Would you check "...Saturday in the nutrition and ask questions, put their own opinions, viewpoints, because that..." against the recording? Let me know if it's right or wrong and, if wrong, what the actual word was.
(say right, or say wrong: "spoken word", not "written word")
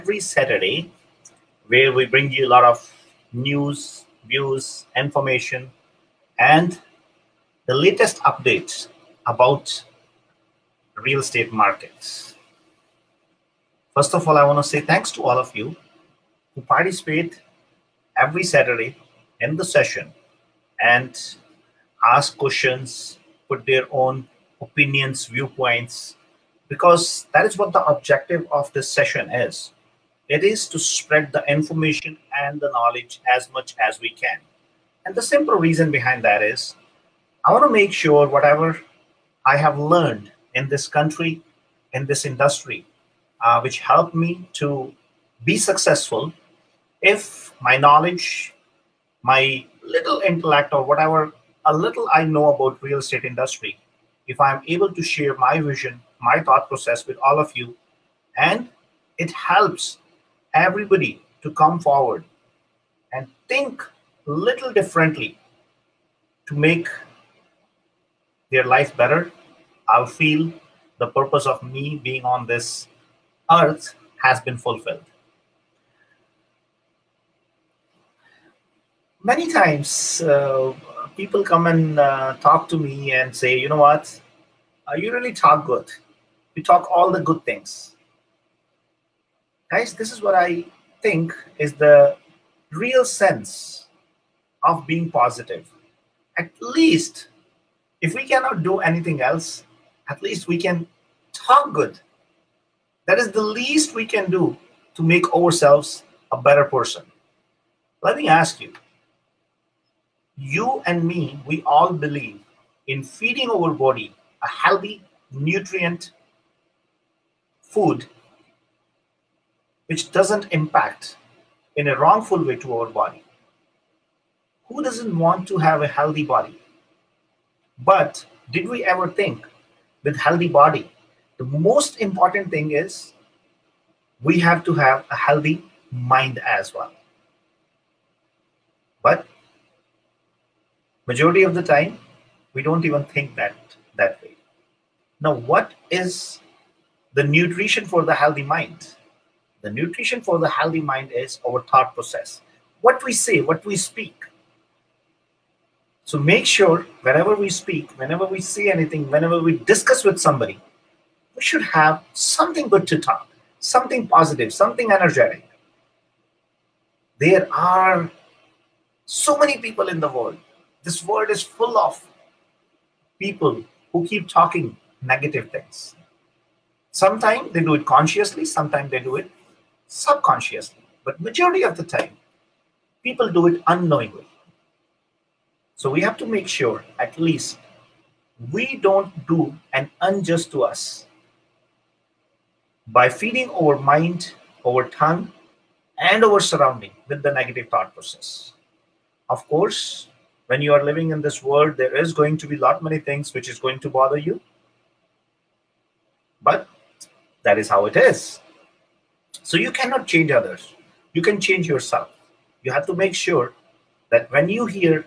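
wrong: "session", not "nutrition".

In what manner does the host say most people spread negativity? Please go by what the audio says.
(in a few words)
unknowingly.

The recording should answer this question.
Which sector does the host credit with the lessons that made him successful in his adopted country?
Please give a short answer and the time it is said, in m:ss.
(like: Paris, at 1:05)
real estate industry, at 0:52.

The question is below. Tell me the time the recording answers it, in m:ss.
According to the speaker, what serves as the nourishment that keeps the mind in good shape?
2:31.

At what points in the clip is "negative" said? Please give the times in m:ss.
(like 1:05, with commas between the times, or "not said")
2:55, 3:17.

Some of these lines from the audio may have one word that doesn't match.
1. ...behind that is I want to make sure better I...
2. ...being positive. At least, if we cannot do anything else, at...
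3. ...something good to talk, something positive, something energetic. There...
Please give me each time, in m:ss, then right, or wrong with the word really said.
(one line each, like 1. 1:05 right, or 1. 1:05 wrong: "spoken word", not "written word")
1. 0:35 wrong: "whatever", not "better"
2. 1:34 right
3. 2:42 right.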